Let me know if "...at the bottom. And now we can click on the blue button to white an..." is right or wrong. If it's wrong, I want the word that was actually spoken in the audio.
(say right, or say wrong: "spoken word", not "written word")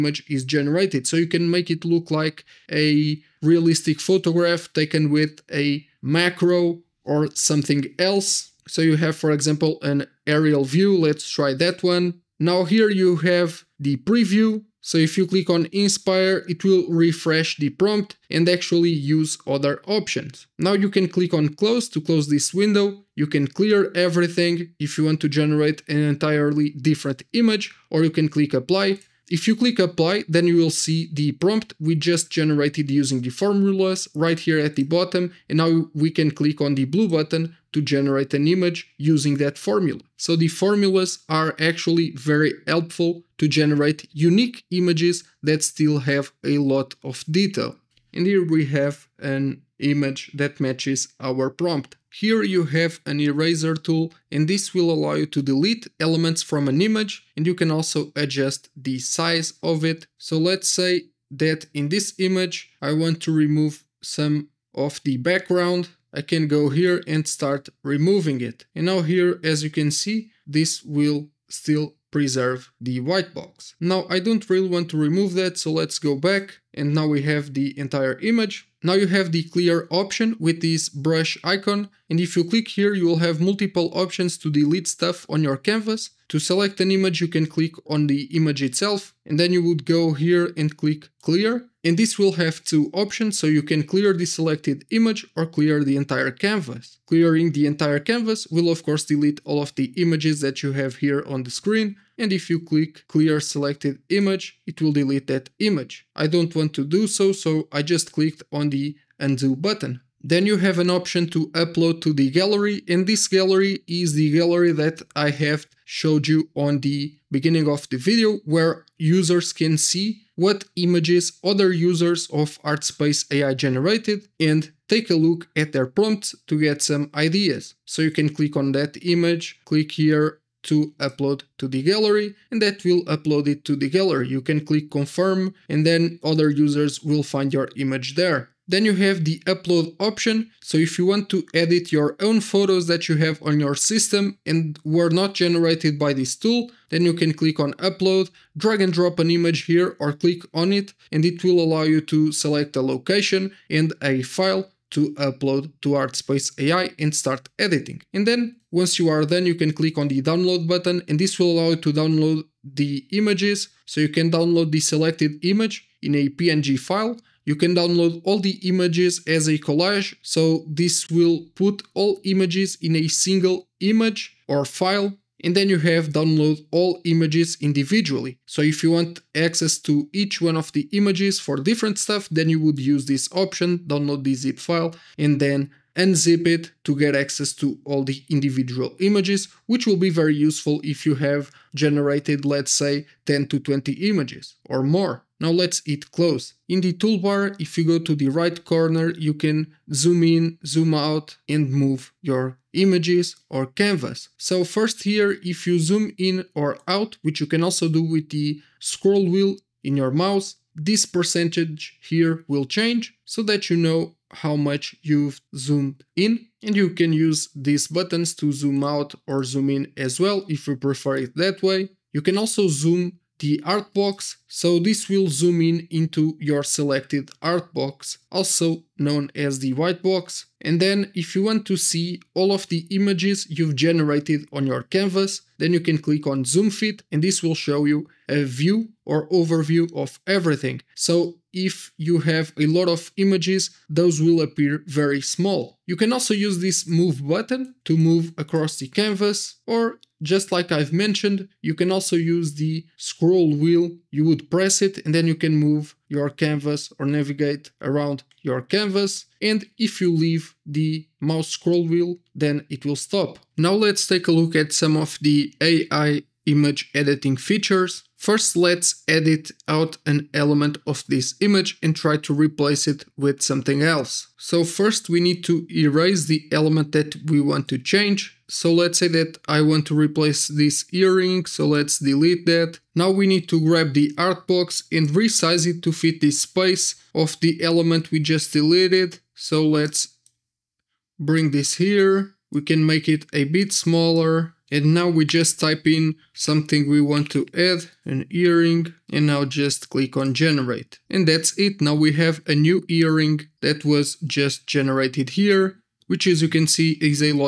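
wrong: "generate", not "white".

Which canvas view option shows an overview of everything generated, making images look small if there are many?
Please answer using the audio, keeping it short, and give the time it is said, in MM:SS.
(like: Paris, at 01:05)
zoom fit, at 03:56.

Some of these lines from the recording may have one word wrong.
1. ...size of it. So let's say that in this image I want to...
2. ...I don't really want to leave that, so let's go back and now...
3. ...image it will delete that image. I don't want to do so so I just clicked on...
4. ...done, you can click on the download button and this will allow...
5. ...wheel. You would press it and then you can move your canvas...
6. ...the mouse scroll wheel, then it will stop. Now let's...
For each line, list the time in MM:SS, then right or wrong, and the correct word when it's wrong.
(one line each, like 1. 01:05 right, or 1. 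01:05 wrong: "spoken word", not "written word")
1. 00:58 right
2. 01:14 wrong: "remove", not "leave"
3. 01:44 right
4. 02:39 right
5. 04:13 right
6. 04:20 right.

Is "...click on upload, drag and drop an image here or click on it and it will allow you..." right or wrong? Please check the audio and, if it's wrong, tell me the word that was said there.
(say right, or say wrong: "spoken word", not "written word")
right.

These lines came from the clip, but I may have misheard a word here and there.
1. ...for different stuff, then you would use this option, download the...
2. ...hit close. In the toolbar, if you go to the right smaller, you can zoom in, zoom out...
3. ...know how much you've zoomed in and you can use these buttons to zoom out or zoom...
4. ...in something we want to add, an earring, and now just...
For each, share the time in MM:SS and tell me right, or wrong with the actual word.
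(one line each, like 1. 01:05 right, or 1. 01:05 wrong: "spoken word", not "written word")
1. 03:01 right
2. 03:15 wrong: "corner", not "smaller"
3. 03:33 right
4. 04:55 right.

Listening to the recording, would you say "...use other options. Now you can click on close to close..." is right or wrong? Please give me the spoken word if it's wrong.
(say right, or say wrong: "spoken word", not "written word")
right.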